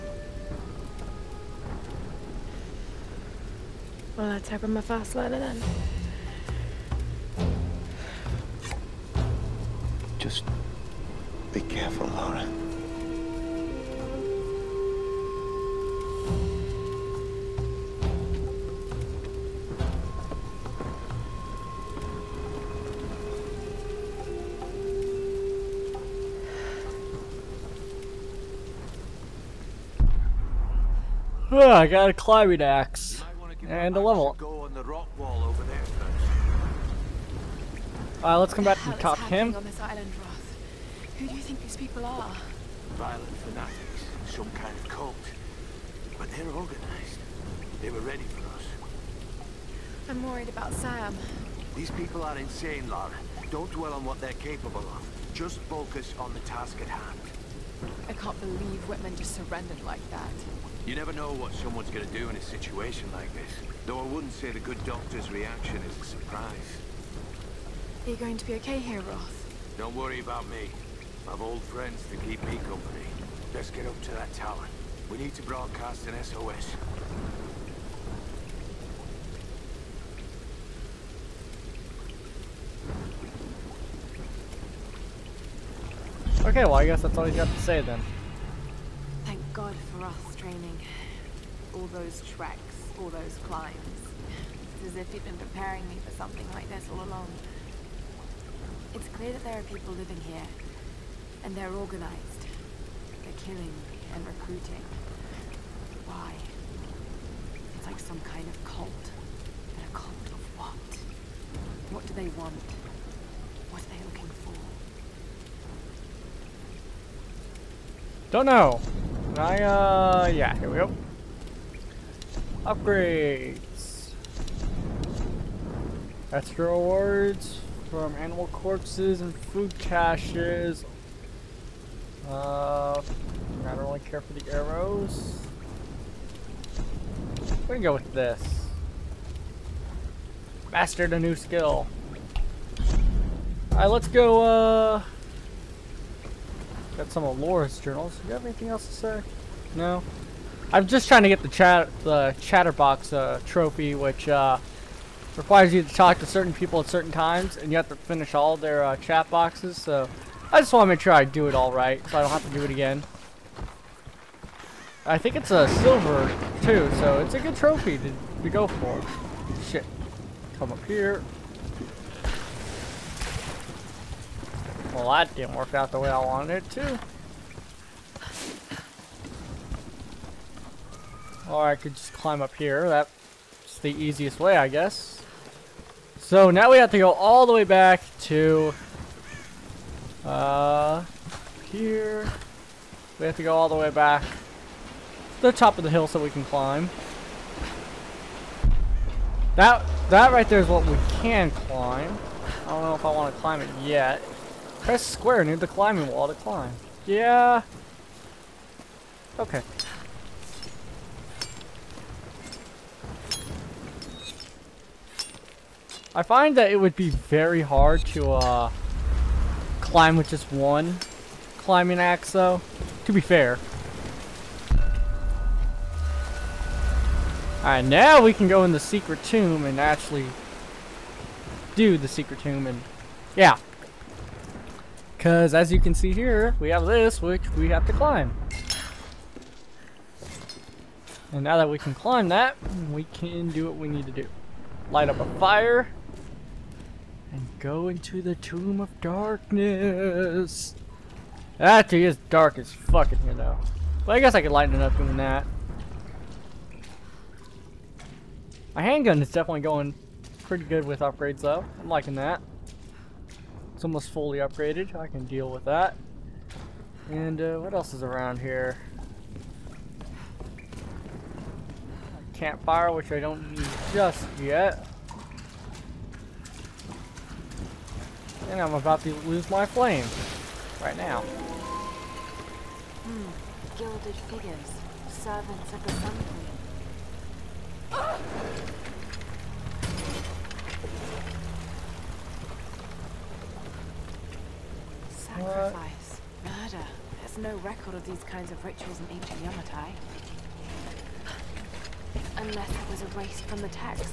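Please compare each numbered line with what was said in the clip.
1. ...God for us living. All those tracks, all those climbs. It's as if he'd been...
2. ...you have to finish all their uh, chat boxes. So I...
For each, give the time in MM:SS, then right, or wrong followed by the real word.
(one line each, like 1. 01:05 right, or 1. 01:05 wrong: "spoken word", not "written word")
1. 01:29 wrong: "training", not "living"
2. 02:37 right.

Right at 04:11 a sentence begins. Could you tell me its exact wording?
That thing is dark as fuck in here though.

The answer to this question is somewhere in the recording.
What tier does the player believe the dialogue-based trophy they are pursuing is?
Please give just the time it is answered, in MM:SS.
02:45.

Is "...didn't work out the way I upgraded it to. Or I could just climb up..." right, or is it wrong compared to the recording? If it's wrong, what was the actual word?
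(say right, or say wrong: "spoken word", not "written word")
wrong: "wanted", not "upgraded".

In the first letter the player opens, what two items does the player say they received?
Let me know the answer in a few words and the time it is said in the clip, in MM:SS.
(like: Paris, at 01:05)
A climbing axe and a level, at 00:32.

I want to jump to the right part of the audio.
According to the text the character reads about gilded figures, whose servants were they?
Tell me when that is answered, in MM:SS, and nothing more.
04:45.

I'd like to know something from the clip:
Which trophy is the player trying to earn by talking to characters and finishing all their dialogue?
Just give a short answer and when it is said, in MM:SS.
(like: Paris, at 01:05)
Chatterbox, at 02:32.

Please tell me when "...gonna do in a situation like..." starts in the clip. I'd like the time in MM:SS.
01:01.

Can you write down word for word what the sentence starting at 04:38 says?
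And I'm about to lose my flame right now.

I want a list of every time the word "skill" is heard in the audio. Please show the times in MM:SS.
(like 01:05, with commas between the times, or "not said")
02:21.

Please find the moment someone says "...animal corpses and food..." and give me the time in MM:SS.
02:08.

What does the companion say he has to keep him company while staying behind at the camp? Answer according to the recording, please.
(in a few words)
Old friends.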